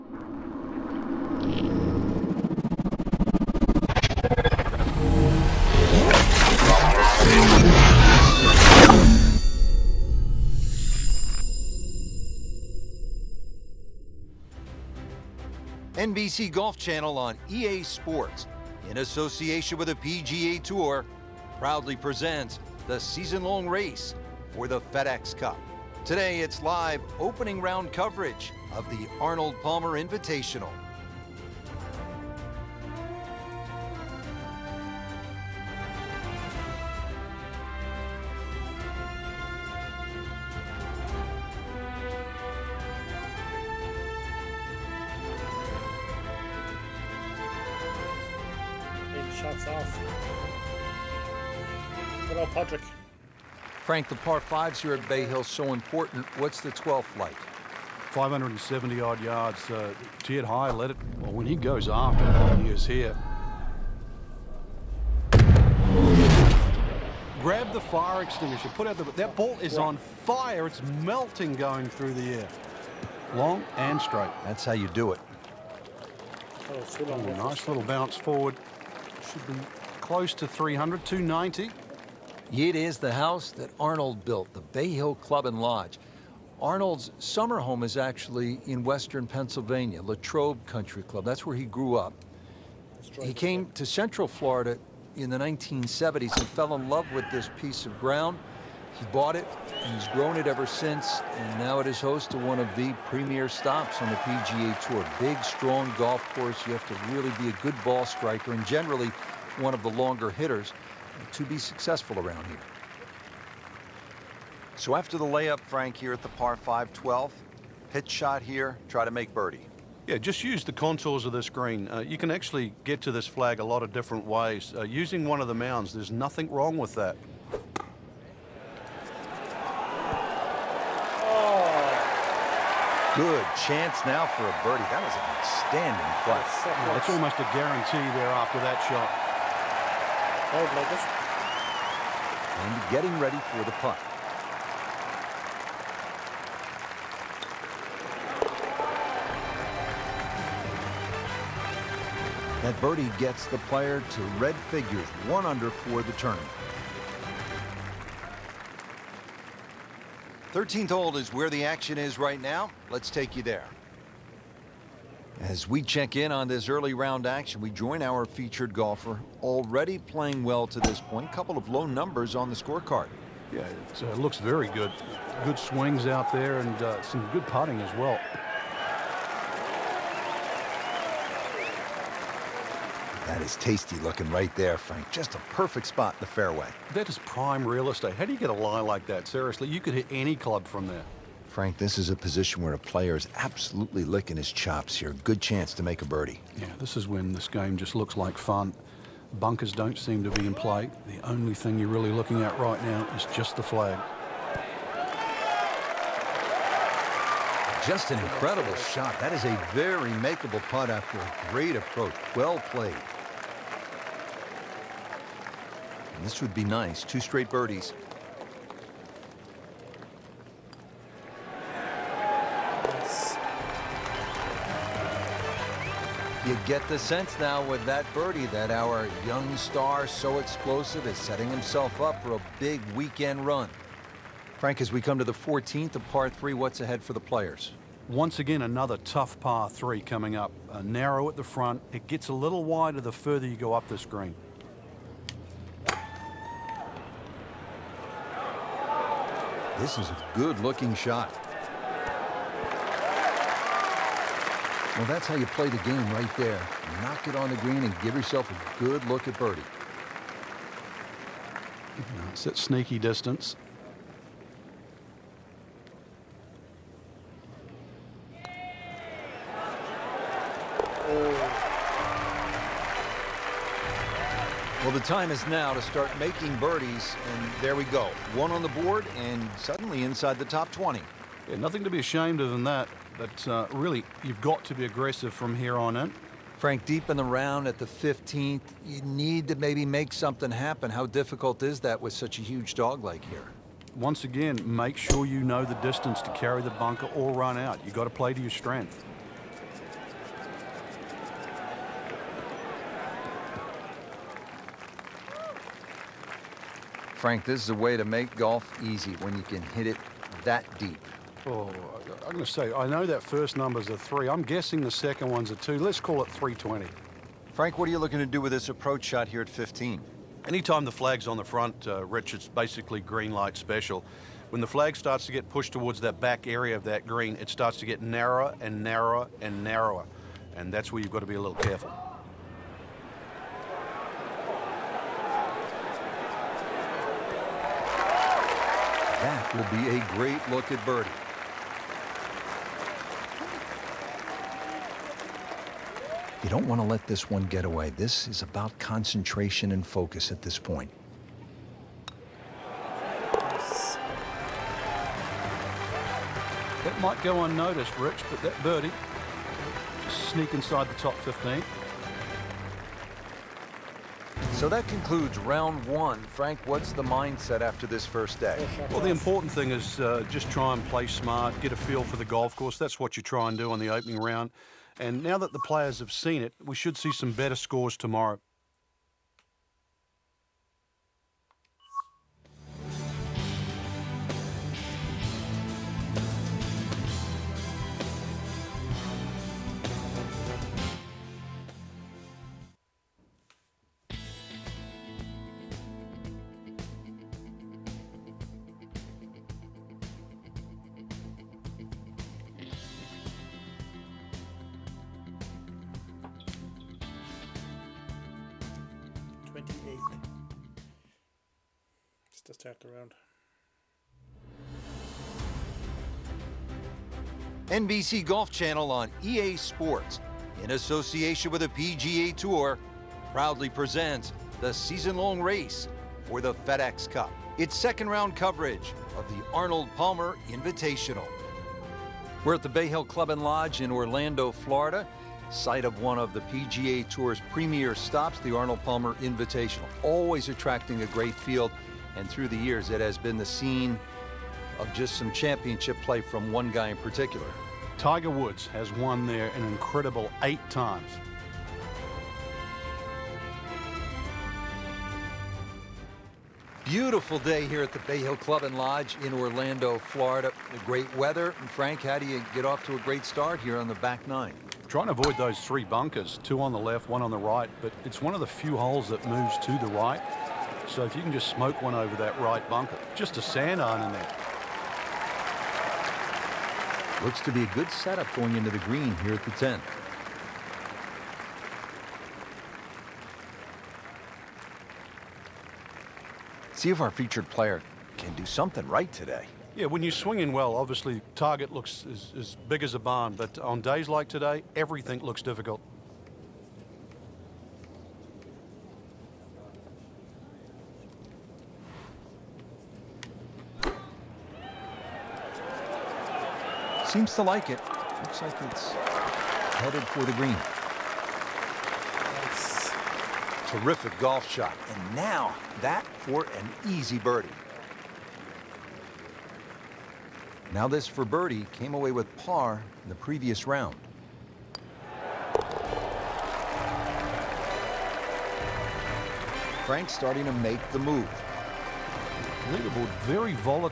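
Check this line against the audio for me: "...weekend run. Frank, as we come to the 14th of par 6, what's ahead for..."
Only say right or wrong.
wrong.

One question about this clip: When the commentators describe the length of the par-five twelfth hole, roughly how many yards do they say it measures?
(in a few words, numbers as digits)
570.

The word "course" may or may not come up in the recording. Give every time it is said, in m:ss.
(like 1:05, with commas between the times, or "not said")
1:46, 6:12.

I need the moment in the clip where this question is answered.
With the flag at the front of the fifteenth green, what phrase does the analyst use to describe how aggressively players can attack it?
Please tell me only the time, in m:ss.
5:22.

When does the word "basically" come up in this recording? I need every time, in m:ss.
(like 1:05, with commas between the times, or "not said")
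5:22.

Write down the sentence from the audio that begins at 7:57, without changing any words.
Looks to be a good setup going into the green here at the 10.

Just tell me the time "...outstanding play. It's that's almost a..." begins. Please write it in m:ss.
2:15.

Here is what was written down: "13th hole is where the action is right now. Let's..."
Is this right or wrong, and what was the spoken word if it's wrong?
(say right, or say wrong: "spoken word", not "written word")
right.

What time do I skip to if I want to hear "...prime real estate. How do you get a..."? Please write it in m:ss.
3:07.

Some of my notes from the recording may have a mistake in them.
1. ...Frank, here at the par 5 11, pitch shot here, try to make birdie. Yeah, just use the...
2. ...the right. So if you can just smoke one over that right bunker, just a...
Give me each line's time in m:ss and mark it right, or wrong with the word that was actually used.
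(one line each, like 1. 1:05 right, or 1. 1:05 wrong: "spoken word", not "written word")
1. 1:55 wrong: "12", not "11"
2. 7:49 right.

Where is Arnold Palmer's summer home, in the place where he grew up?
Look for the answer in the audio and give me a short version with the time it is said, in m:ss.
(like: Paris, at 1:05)
Latrobe Country Club, at 1:30.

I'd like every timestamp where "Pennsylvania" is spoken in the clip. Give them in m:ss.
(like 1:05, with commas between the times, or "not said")
1:29.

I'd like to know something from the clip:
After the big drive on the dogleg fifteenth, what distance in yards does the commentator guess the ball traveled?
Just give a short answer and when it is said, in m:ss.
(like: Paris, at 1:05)
320, at 5:16.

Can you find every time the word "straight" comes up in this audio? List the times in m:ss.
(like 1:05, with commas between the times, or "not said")
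1:13, 3:37.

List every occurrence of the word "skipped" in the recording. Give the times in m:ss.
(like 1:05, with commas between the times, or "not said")
not said.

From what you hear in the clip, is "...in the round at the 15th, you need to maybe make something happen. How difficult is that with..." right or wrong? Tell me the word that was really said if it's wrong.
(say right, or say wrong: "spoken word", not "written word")
right.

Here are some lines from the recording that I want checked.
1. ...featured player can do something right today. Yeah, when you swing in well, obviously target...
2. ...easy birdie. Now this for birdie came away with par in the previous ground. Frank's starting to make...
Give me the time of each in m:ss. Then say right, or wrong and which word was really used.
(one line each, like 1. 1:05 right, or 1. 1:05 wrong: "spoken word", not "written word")
1. 8:07 right
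2. 8:36 wrong: "round", not "ground".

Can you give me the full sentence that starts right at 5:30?
And that's where you've got to be a little careful.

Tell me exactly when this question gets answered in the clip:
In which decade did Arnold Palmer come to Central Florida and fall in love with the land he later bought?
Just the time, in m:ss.
1:35.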